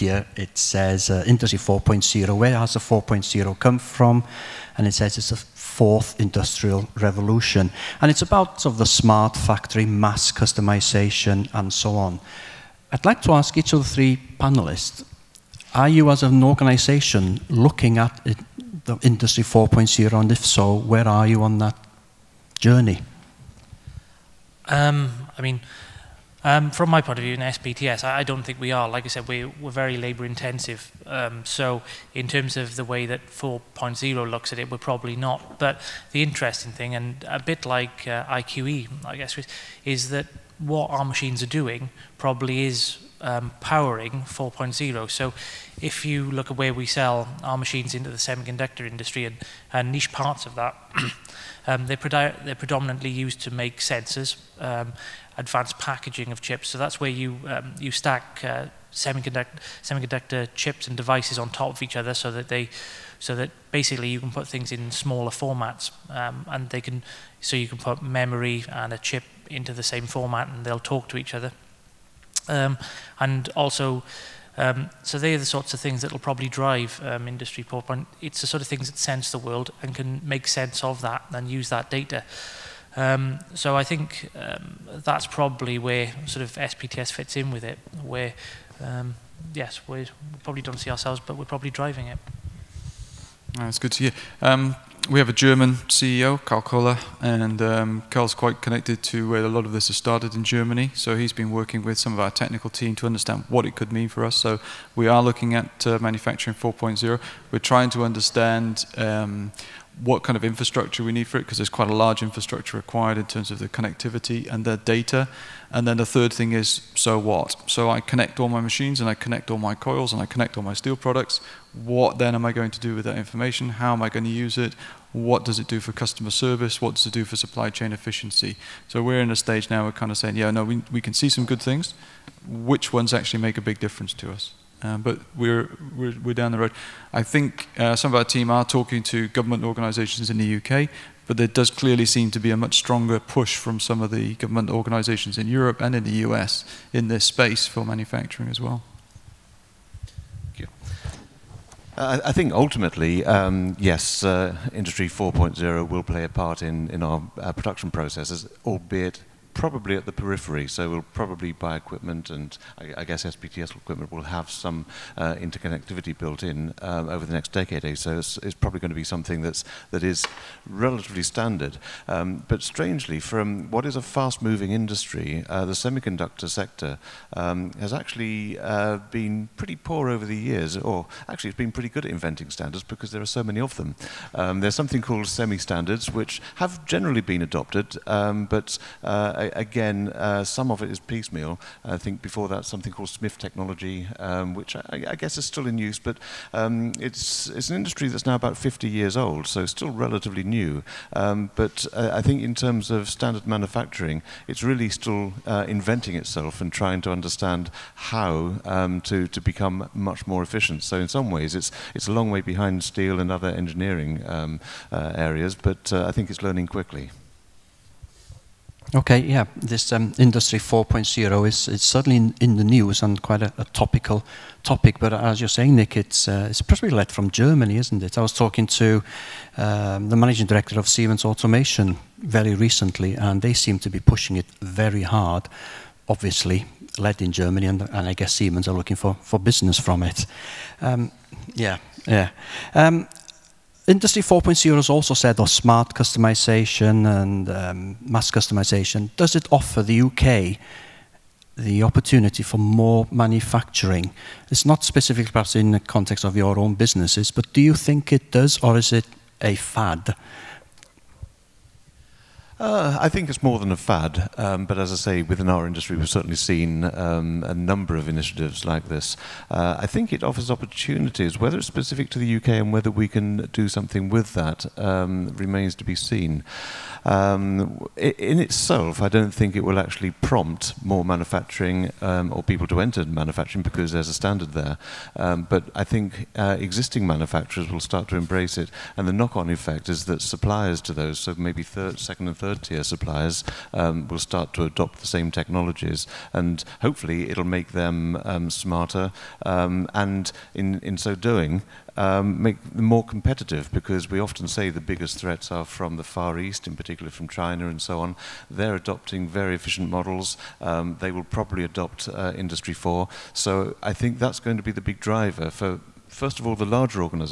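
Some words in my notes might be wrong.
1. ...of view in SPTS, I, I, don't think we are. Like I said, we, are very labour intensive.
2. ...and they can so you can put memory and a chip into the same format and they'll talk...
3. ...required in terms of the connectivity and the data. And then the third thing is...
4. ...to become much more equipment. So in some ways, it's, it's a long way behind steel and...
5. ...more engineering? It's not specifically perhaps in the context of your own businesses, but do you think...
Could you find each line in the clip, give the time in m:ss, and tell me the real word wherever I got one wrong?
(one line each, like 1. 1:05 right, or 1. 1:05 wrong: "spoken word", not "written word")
1. 0:27 right
2. 1:06 right
3. 1:52 right
4. 3:29 wrong: "efficient", not "equipment"
5. 4:12 wrong: "manufacturing", not "engineering".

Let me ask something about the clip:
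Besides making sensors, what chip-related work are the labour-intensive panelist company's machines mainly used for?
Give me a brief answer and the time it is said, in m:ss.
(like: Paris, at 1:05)
advanced packaging, at 0:55.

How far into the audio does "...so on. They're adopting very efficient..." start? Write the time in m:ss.
5:07.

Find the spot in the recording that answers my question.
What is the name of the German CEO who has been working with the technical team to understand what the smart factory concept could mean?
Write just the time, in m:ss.
1:36.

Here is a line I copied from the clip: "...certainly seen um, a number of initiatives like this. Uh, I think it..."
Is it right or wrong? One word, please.
right.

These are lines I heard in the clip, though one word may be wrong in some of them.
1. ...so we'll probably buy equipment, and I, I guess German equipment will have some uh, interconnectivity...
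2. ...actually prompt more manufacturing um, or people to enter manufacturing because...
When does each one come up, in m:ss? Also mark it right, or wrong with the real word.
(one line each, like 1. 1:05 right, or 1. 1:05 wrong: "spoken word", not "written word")
1. 2:40 wrong: "SPTS", not "German"
2. 4:39 right.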